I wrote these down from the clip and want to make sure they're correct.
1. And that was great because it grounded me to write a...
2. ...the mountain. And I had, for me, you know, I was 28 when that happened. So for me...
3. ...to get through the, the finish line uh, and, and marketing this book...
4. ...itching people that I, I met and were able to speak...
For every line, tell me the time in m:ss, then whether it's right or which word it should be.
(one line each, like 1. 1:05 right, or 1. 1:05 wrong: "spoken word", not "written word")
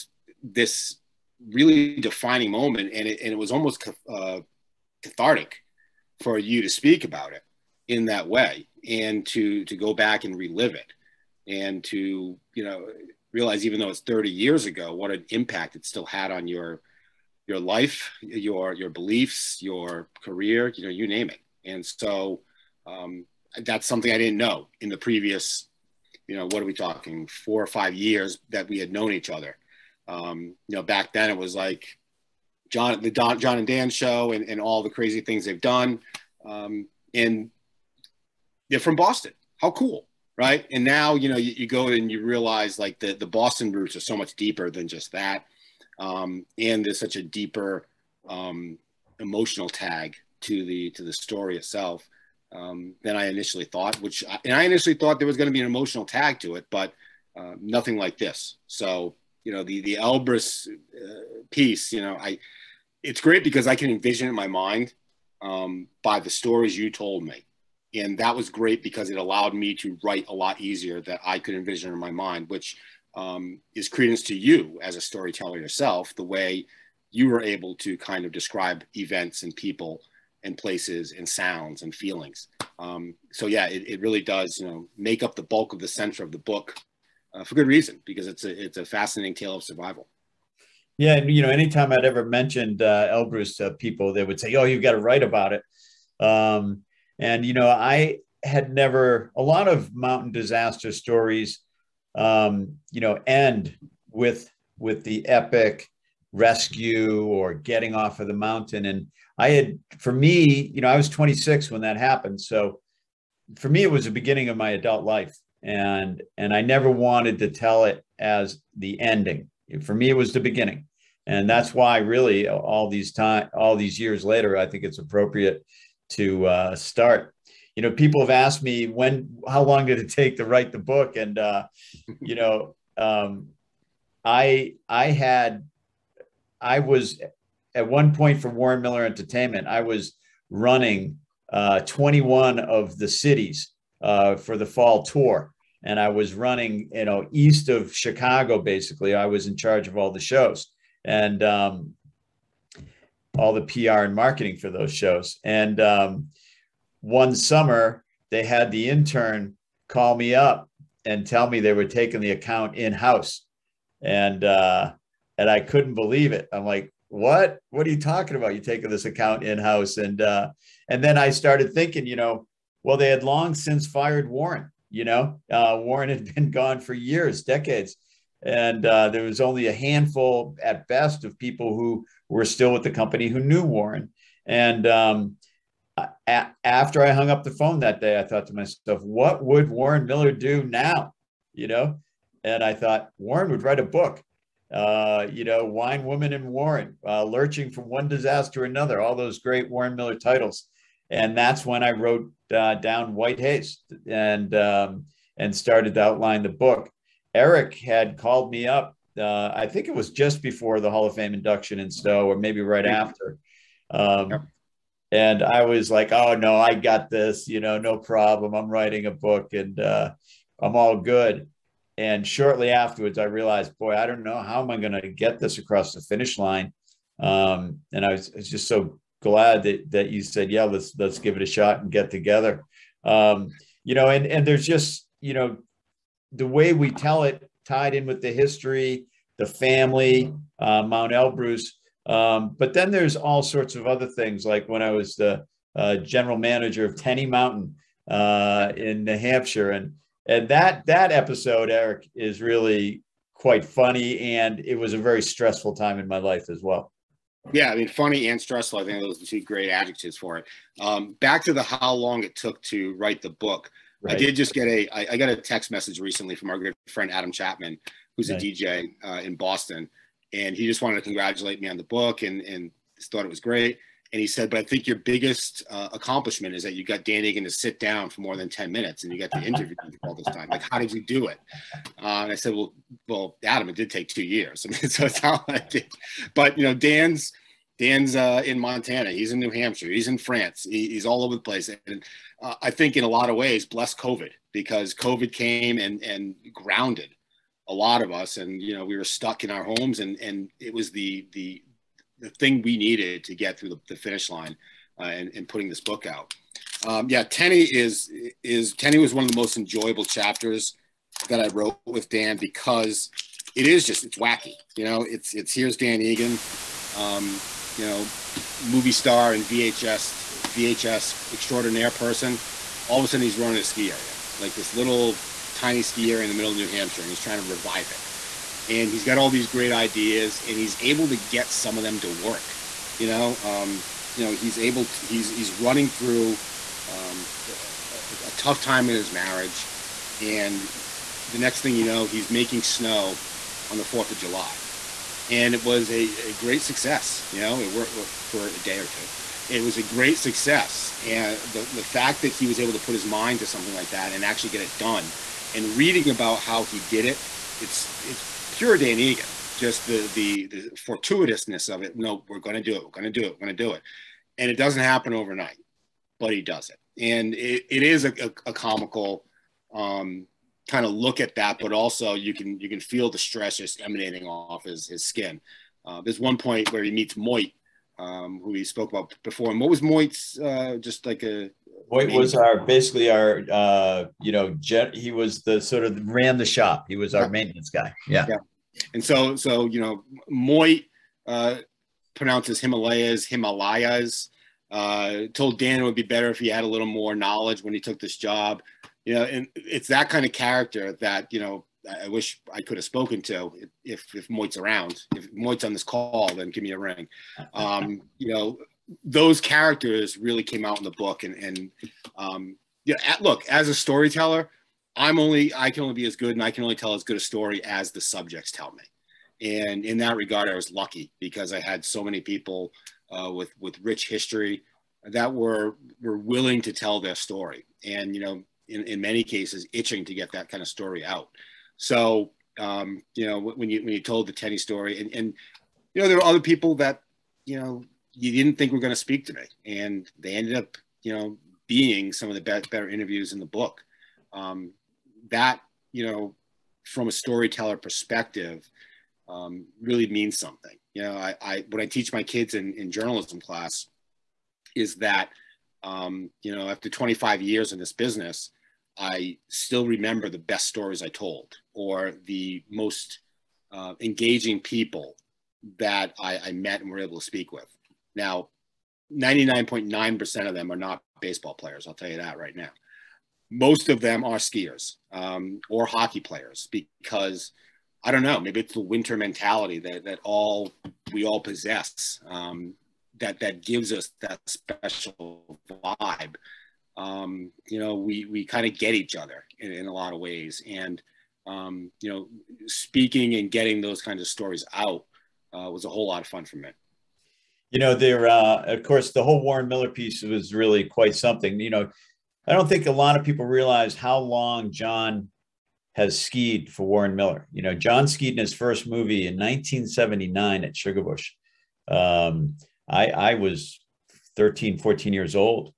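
1. 1:07 wrong: "allowed", not "grounded"
2. 1:48 wrong: "26", not "28"
3. 5:03 wrong: "putting", not "marketing"
4. 7:44 wrong: "engaging", not "itching".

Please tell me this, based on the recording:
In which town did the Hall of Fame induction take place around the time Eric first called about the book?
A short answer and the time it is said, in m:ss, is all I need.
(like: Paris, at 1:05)
Stowe, at 3:31.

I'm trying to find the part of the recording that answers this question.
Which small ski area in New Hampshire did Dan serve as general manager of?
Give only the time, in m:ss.
4:06.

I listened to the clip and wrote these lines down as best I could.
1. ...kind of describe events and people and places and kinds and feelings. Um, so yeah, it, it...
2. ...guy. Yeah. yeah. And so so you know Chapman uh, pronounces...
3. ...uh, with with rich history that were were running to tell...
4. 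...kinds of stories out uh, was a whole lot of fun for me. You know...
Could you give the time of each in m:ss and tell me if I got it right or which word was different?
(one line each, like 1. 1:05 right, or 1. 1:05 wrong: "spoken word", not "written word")
1. 1:17 wrong: "sounds", not "kinds"
2. 6:27 wrong: "Moit", not "Chapman"
3. 7:03 wrong: "willing", not "running"
4. 8:14 right.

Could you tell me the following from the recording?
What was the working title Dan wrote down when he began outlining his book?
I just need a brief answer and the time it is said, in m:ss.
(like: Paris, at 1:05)
White Haze, at 3:23.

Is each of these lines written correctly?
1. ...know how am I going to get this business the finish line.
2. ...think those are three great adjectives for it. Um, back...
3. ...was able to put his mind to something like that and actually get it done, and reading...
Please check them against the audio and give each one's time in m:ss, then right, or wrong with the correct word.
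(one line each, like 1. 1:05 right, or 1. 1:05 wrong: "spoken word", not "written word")
1. 3:44 wrong: "across", not "business"
2. 4:18 wrong: "two", not "three"
3. 5:52 right.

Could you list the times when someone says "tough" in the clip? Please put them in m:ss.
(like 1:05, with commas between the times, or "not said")
5:38.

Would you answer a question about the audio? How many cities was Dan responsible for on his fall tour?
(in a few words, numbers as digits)
21.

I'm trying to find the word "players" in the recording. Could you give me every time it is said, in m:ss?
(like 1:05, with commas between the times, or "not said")
7:51, 7:56.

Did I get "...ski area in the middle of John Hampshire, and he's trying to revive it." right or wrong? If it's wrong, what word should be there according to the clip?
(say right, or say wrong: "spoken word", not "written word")
wrong: "New", not "John".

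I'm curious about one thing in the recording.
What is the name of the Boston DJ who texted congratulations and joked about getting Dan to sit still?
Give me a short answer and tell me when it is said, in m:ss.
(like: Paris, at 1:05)
Adam Chapman, at 4:27.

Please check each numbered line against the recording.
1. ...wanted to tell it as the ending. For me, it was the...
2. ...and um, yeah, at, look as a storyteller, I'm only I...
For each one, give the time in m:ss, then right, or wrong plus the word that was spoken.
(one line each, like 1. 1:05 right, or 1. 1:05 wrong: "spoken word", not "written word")
1. 1:56 right
2. 6:51 right.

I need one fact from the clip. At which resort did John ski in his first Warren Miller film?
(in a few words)
Sugarbush.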